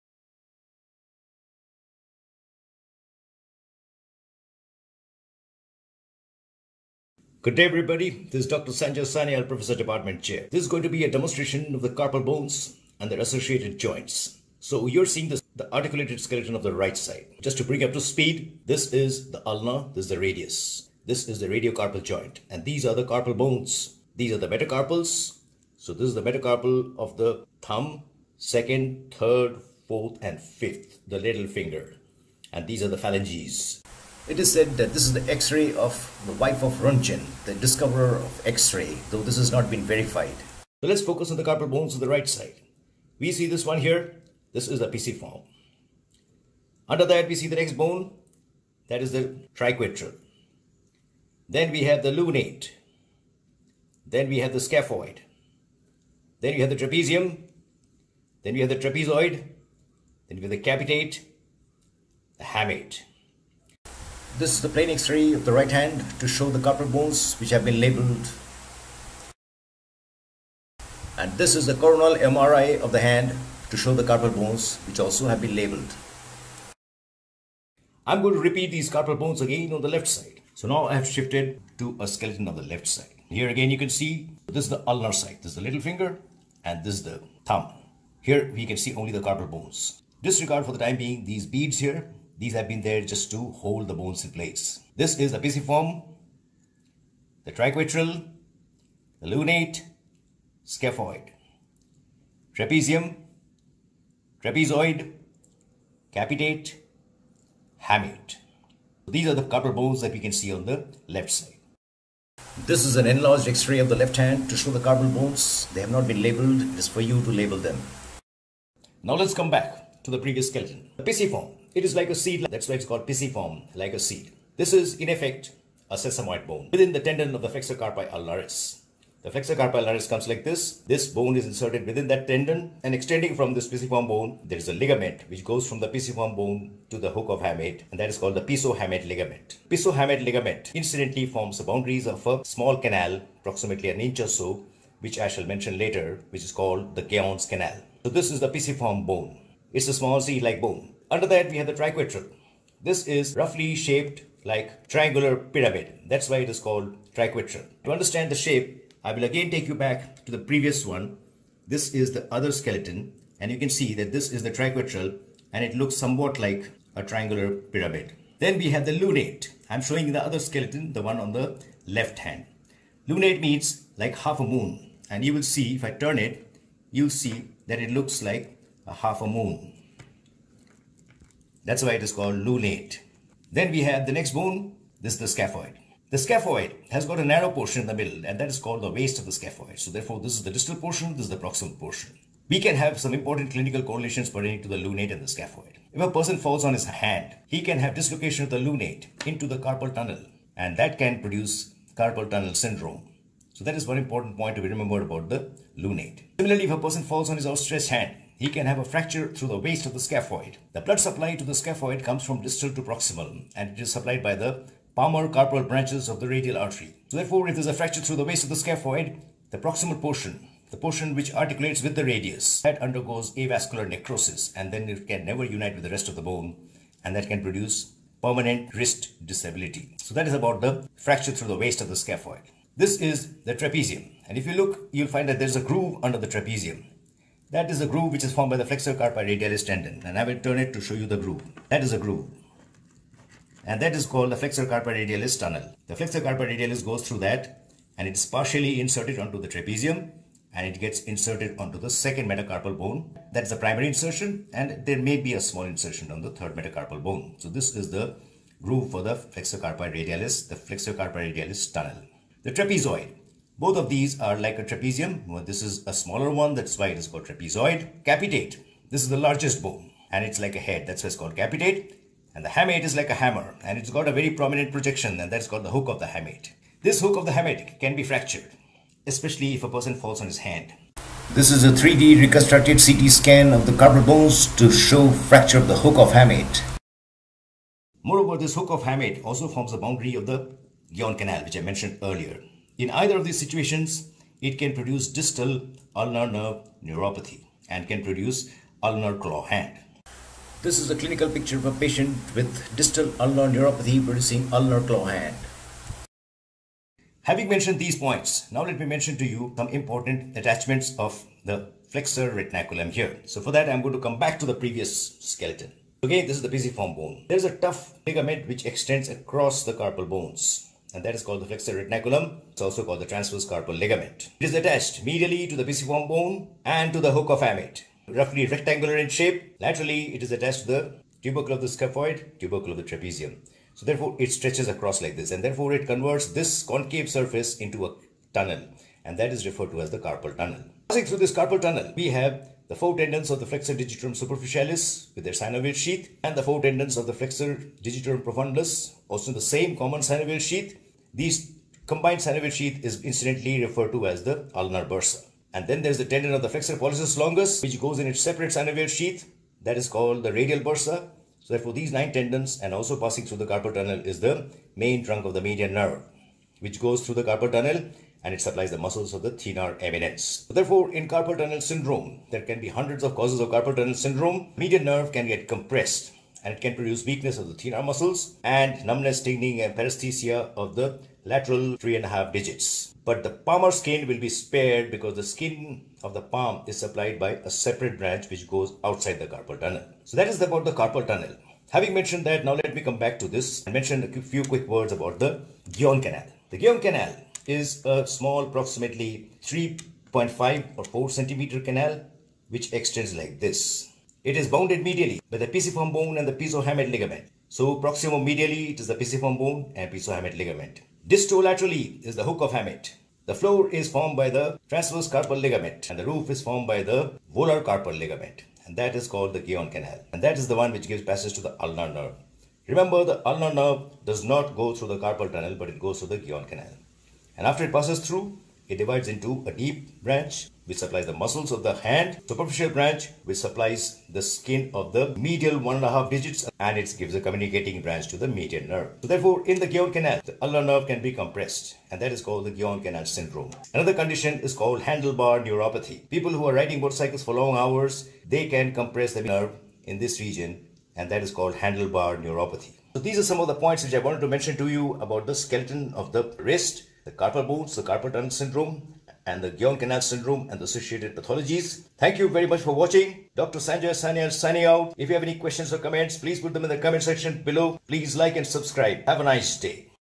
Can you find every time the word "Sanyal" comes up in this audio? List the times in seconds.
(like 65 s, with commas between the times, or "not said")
9 s, 464 s.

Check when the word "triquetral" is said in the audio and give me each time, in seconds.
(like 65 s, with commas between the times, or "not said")
49 s, 97 s, 151 s, 157 s, 164 s.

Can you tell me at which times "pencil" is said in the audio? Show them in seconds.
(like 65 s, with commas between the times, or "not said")
not said.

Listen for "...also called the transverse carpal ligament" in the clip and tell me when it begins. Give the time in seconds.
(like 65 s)
322 s.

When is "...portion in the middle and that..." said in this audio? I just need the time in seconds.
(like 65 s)
187 s.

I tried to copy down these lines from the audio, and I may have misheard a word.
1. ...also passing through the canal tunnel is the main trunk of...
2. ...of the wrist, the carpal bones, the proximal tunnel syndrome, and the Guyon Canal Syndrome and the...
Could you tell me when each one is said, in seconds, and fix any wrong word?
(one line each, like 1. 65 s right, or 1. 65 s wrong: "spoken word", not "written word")
1. 362 s wrong: "carpal", not "canal"
2. 455 s wrong: "carpal", not "proximal".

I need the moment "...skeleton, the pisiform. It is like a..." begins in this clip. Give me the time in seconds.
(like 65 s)
120 s.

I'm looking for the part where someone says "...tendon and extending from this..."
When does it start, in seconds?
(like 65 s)
132 s.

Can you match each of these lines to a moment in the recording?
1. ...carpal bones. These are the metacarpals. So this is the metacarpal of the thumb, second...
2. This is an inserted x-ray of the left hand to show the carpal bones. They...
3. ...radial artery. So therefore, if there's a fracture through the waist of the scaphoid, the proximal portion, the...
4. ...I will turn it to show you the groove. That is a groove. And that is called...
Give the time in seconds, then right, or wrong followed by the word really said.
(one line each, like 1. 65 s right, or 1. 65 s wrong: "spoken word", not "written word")
1. 23 s right
2. 112 s wrong: "enlarged", not "inserted"
3. 216 s right
4. 240 s right.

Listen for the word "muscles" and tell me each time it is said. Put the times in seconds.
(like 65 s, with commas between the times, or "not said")
368 s, 377 s, 431 s.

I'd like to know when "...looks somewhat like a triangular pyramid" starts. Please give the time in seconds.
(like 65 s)
165 s.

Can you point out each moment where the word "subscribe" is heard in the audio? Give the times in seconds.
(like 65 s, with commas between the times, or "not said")
468 s.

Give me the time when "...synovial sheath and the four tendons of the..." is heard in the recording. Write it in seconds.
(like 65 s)
345 s.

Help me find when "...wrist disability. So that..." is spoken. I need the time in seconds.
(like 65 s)
228 s.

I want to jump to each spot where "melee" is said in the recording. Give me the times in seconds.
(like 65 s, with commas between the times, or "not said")
not said.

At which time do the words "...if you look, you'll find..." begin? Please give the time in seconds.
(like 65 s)
234 s.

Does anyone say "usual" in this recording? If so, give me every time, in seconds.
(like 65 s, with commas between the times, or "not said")
not said.